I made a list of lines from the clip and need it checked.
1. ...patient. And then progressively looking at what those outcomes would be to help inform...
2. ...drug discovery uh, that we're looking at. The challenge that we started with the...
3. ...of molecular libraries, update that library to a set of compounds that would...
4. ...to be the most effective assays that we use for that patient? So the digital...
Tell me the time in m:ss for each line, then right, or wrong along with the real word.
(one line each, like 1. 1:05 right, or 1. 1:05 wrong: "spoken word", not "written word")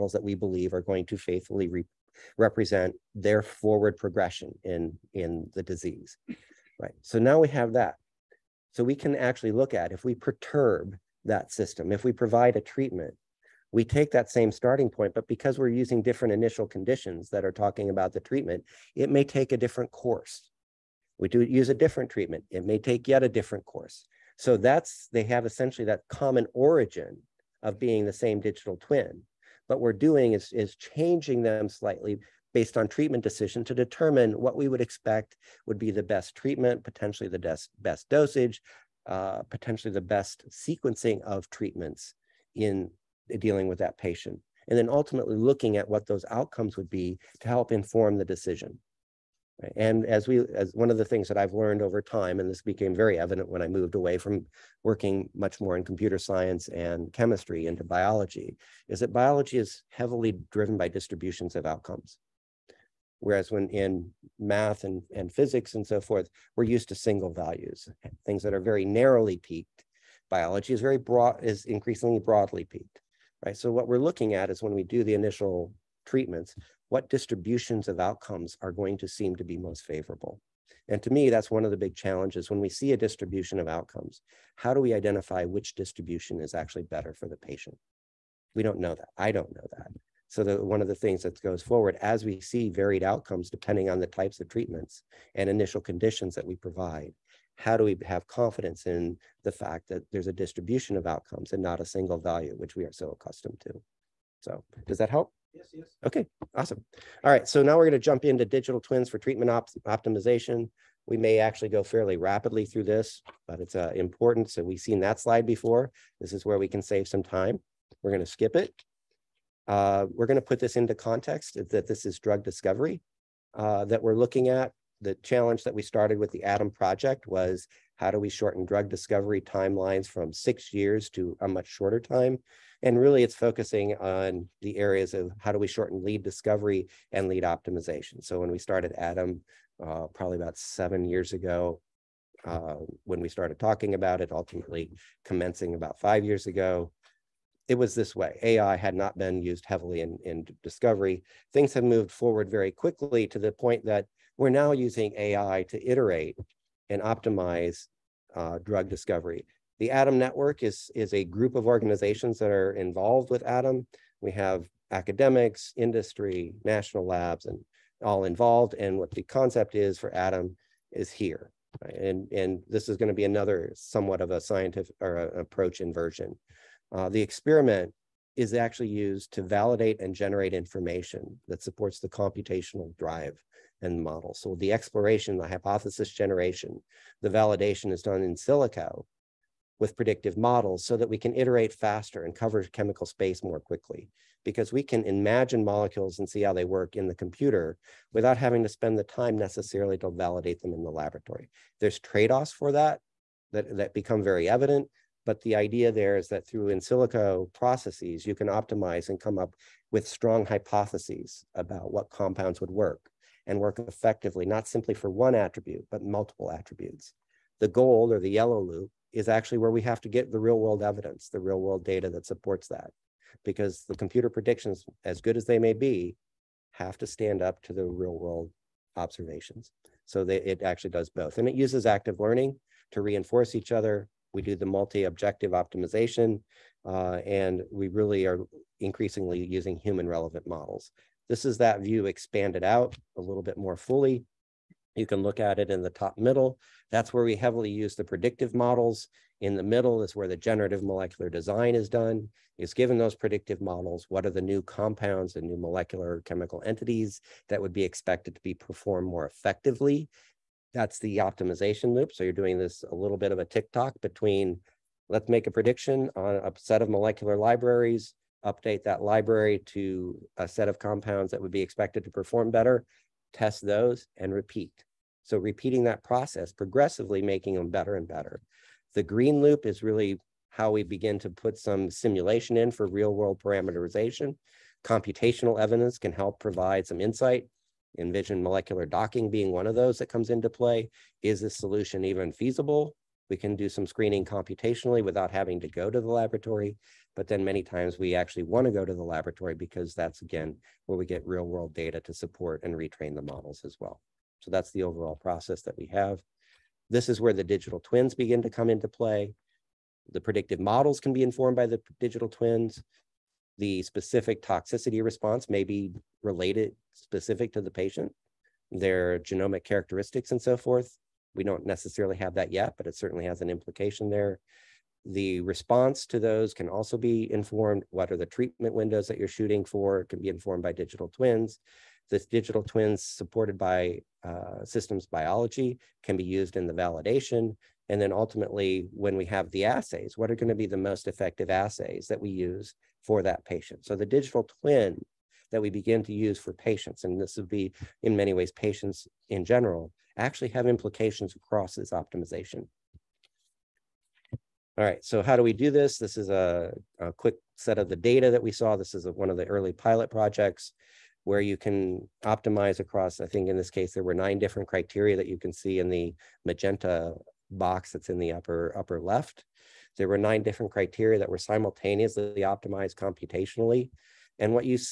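1. 0:43 wrong: "ultimately", not "progressively"
2. 2:02 right
3. 4:26 right
4. 5:40 right.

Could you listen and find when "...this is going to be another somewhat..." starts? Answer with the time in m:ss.
2:52.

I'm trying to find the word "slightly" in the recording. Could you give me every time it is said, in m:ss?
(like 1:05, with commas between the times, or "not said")
0:31.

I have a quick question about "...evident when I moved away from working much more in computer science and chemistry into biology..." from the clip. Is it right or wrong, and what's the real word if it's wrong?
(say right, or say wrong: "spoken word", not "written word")
right.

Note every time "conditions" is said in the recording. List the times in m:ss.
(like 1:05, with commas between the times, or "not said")
0:16, 1:35.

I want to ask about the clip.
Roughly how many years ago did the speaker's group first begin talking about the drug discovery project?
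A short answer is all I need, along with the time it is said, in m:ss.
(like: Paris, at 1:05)
7 years, at 2:20.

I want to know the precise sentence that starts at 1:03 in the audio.
Whereas when in math and, and physics and so forth, we're used to single values, things that are very narrowly peaked.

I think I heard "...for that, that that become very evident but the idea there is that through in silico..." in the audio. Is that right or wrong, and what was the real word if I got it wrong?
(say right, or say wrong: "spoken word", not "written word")
right.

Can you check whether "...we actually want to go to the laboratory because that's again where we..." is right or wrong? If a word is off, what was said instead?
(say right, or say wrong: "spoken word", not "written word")
right.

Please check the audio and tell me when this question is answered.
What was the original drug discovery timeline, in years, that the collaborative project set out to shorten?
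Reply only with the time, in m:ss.
2:10.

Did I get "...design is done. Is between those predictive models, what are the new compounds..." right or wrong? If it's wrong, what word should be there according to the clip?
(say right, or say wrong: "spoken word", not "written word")
wrong: "given", not "between".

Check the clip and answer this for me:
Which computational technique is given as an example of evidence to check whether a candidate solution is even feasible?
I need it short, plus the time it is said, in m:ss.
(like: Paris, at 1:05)
Molecular docking, at 4:48.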